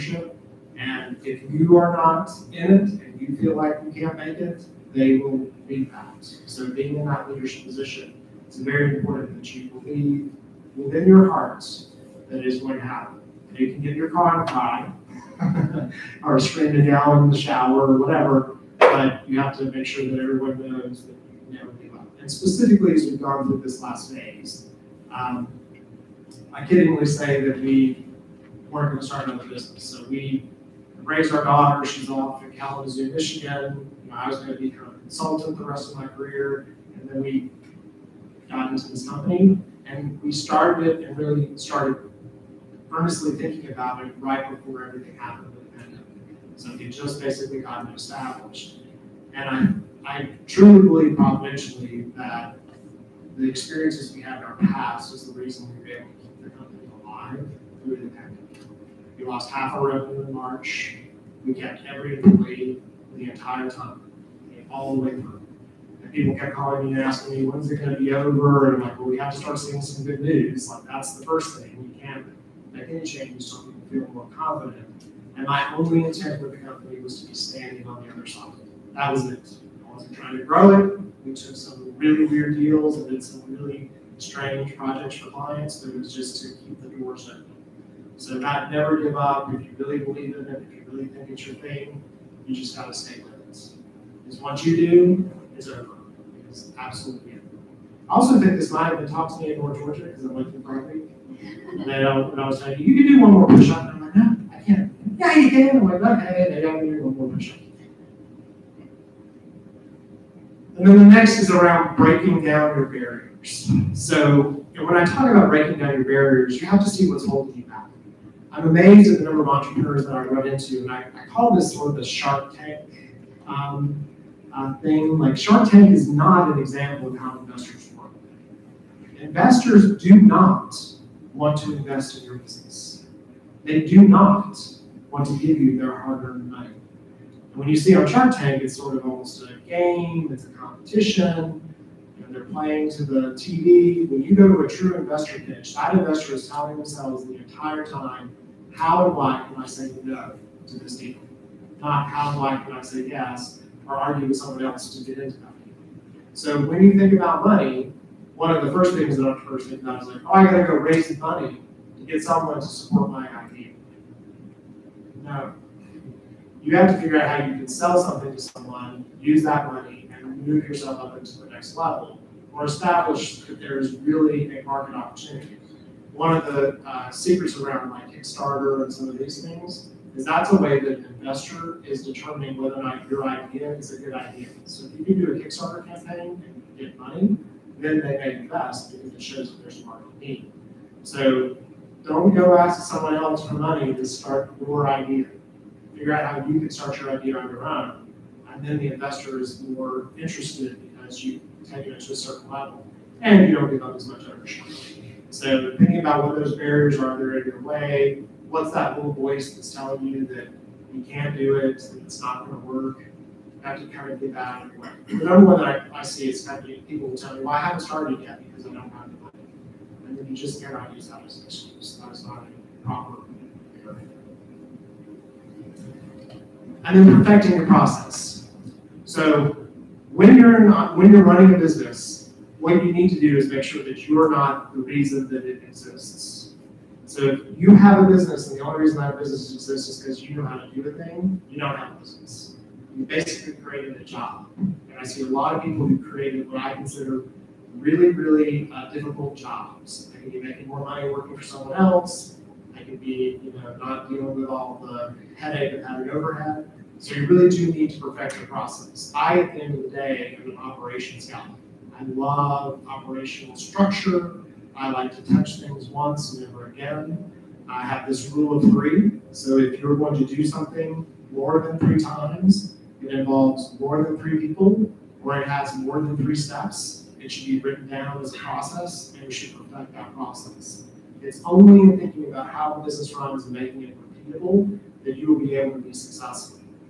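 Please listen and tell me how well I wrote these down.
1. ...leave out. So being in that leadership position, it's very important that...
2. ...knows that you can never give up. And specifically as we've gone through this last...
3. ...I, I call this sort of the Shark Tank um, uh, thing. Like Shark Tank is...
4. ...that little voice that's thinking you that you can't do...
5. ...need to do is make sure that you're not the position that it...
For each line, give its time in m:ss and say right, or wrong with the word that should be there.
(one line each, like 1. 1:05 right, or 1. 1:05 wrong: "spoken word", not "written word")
1. 0:05 right
2. 0:20 right
3. 2:00 right
4. 3:28 wrong: "telling", not "thinking"
5. 3:52 wrong: "reason", not "position".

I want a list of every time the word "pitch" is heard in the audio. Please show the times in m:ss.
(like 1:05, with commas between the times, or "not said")
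2:25.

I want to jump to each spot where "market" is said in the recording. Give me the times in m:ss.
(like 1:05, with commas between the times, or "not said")
2:54, 3:09.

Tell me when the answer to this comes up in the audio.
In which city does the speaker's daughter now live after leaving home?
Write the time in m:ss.
0:32.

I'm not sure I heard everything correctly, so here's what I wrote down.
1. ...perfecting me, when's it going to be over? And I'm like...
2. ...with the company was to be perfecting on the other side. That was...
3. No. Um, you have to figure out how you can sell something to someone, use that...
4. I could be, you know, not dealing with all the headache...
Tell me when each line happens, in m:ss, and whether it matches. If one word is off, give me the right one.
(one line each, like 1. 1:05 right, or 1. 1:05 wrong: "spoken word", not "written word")
1. 1:07 wrong: "asking", not "perfecting"
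2. 1:16 wrong: "standing", not "perfecting"
3. 2:45 right
4. 4:12 right.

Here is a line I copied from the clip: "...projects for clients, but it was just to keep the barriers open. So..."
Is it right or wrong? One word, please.
wrong.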